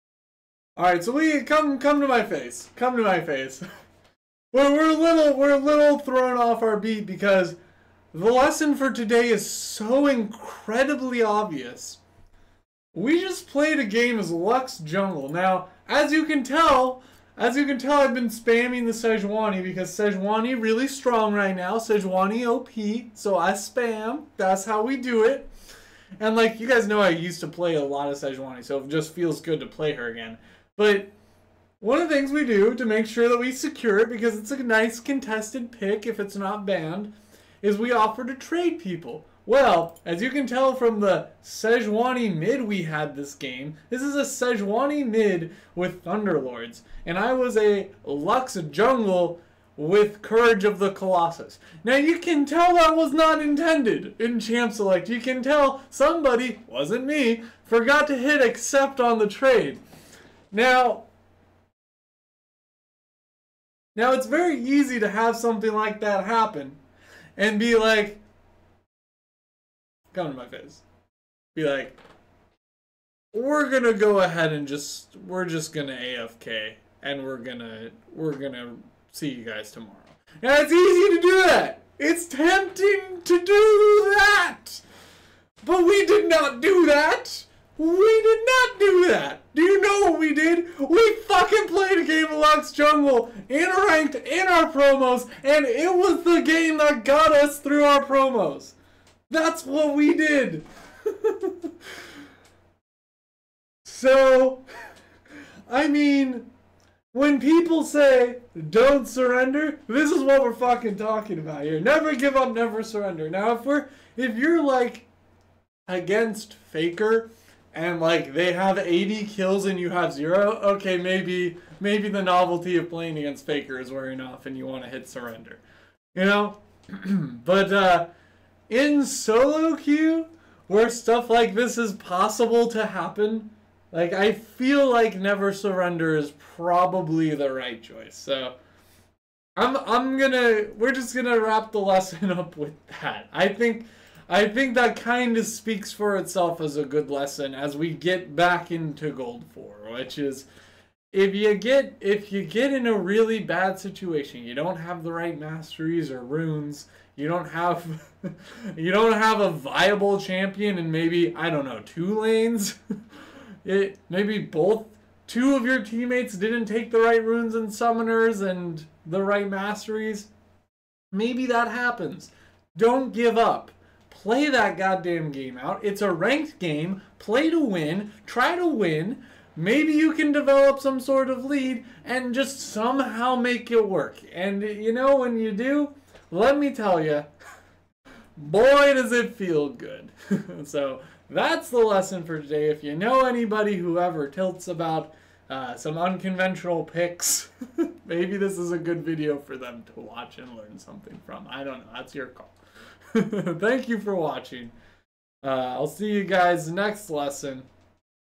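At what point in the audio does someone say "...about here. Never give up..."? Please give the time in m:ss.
1:51.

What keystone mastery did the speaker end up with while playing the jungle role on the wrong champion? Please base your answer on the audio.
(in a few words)
Courage of the Colossus.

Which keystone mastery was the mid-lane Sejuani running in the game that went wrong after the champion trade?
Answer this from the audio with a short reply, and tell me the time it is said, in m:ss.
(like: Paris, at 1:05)
Thunderlords, at 0:46.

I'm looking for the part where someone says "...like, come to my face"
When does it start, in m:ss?
1:07.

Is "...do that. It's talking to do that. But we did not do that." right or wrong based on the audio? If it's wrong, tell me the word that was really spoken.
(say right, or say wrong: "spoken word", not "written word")
wrong: "tempting", not "talking".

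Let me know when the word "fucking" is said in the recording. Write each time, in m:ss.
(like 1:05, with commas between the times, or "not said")
1:31, 1:50.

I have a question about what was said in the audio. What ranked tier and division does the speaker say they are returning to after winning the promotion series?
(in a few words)
Gold 4.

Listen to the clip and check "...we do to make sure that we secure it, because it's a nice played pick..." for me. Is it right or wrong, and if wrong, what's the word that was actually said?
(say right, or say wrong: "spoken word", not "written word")
wrong: "contested", not "played".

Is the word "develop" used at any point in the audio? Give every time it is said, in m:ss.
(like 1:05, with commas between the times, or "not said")
3:00.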